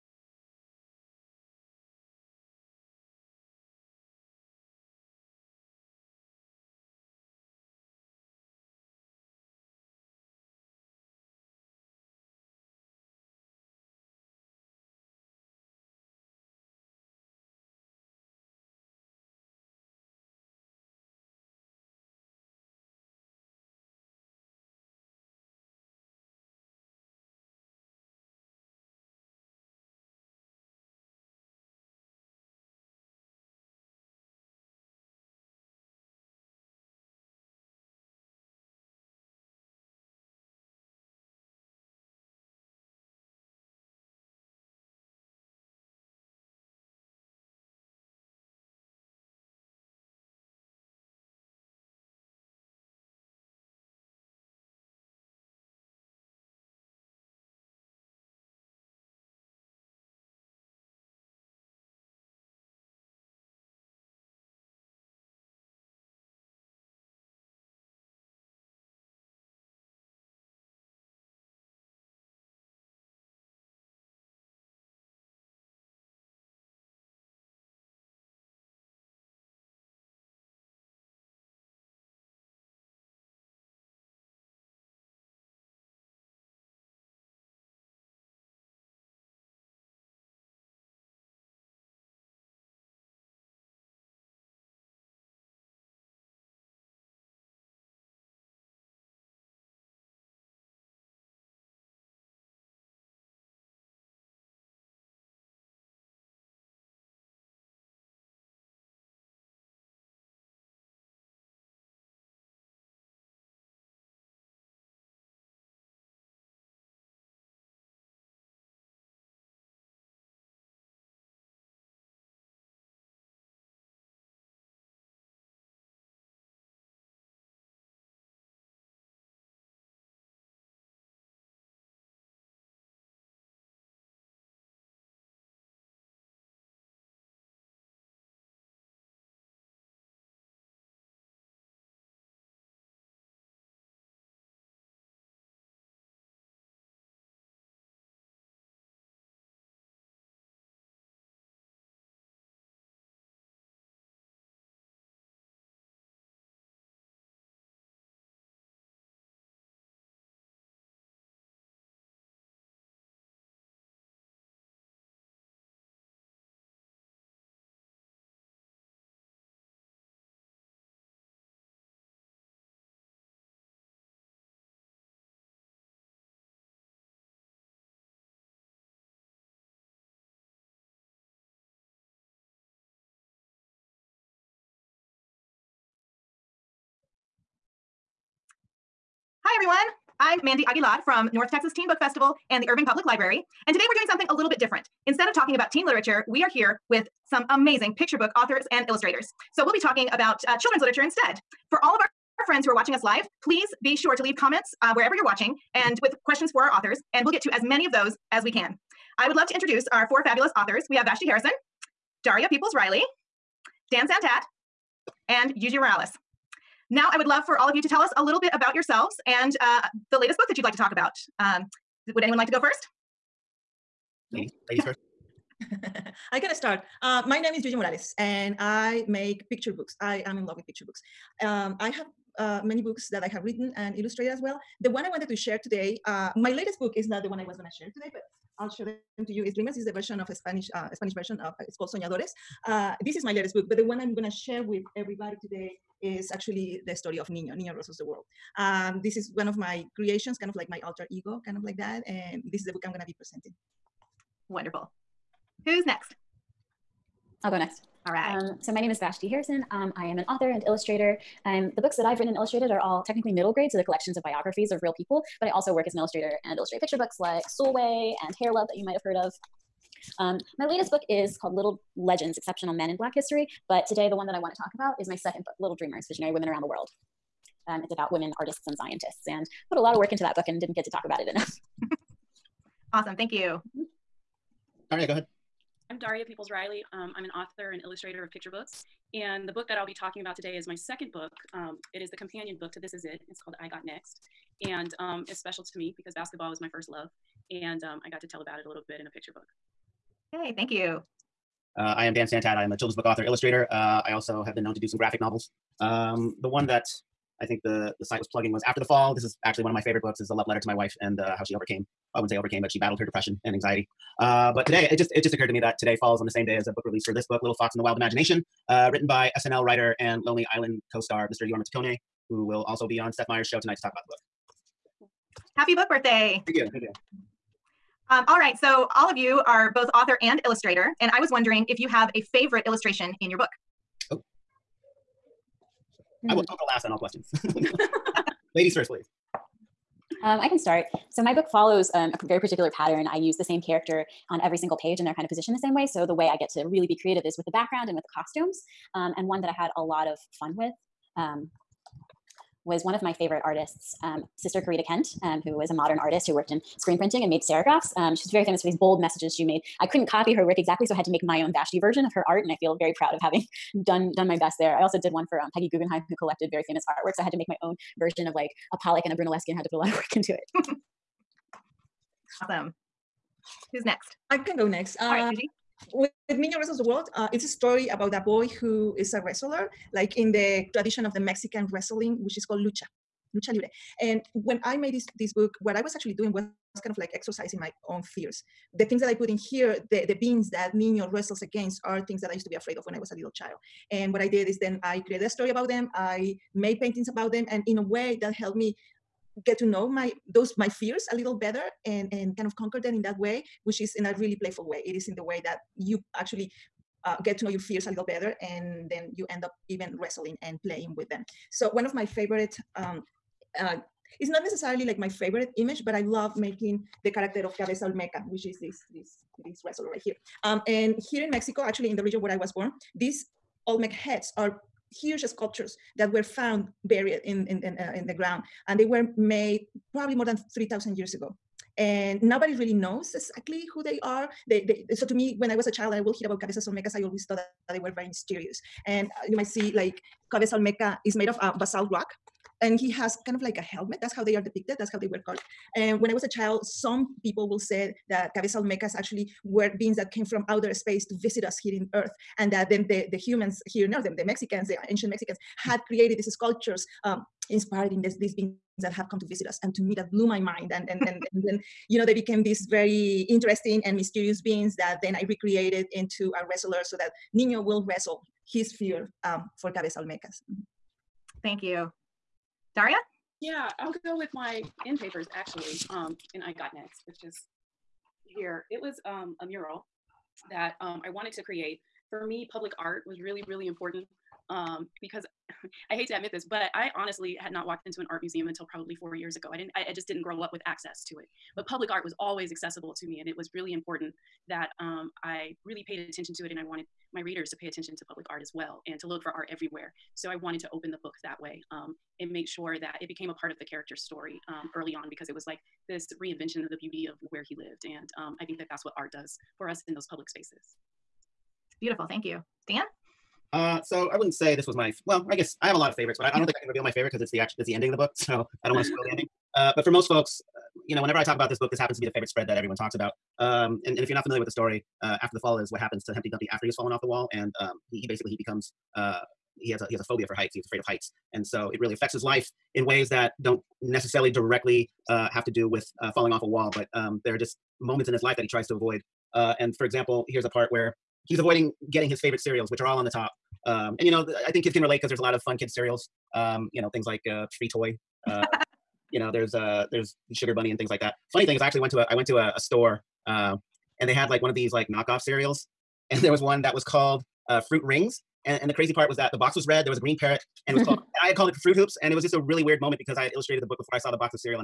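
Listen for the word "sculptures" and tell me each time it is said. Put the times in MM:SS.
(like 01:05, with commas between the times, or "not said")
07:05, 07:36.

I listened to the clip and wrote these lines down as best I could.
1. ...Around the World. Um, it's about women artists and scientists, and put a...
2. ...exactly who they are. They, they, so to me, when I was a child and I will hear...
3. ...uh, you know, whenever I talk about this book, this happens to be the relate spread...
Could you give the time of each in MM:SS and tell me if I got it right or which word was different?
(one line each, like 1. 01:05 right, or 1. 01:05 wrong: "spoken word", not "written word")
1. 04:36 right
2. 07:13 right
3. 08:40 wrong: "favorite", not "relate".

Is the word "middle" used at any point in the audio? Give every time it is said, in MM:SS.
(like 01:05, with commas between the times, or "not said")
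04:23.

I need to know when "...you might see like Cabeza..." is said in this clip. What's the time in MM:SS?
07:19.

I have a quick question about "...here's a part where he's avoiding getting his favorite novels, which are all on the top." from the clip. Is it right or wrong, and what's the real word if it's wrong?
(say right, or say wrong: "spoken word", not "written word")
wrong: "cereals", not "novels".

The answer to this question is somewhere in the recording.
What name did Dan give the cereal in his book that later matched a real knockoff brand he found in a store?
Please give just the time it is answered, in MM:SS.
09:21.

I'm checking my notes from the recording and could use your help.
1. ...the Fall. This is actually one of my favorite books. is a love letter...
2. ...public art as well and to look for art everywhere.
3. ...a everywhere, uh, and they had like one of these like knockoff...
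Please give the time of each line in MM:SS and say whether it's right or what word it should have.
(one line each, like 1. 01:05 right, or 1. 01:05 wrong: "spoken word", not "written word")
1. 05:08 right
2. 08:18 right
3. 09:12 wrong: "store", not "everywhere".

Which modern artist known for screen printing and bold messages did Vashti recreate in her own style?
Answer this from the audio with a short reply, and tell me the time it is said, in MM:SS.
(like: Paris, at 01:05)
Corita Kent, at 05:54.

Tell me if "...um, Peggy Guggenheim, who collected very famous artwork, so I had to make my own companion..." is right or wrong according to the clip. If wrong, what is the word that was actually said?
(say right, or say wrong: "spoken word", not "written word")
wrong: "version", not "companion".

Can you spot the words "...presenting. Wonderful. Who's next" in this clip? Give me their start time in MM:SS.
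04:13.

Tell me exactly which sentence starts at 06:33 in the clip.
And what I did is then I created a story about them.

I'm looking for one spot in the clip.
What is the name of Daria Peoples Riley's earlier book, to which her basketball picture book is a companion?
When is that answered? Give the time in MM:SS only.
04:52.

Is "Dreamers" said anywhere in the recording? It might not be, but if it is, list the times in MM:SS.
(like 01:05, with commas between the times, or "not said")
03:59, 04:35.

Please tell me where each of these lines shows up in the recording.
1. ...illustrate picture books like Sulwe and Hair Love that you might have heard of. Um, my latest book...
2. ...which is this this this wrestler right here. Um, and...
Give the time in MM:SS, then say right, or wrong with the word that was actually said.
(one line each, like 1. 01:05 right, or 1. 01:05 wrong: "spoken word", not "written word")
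1. 04:26 right
2. 06:58 right.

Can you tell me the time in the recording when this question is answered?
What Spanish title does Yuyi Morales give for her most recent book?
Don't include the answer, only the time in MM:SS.
04:01.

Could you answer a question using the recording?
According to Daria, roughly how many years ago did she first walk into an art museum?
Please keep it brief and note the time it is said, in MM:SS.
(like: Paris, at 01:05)
4, at 08:08.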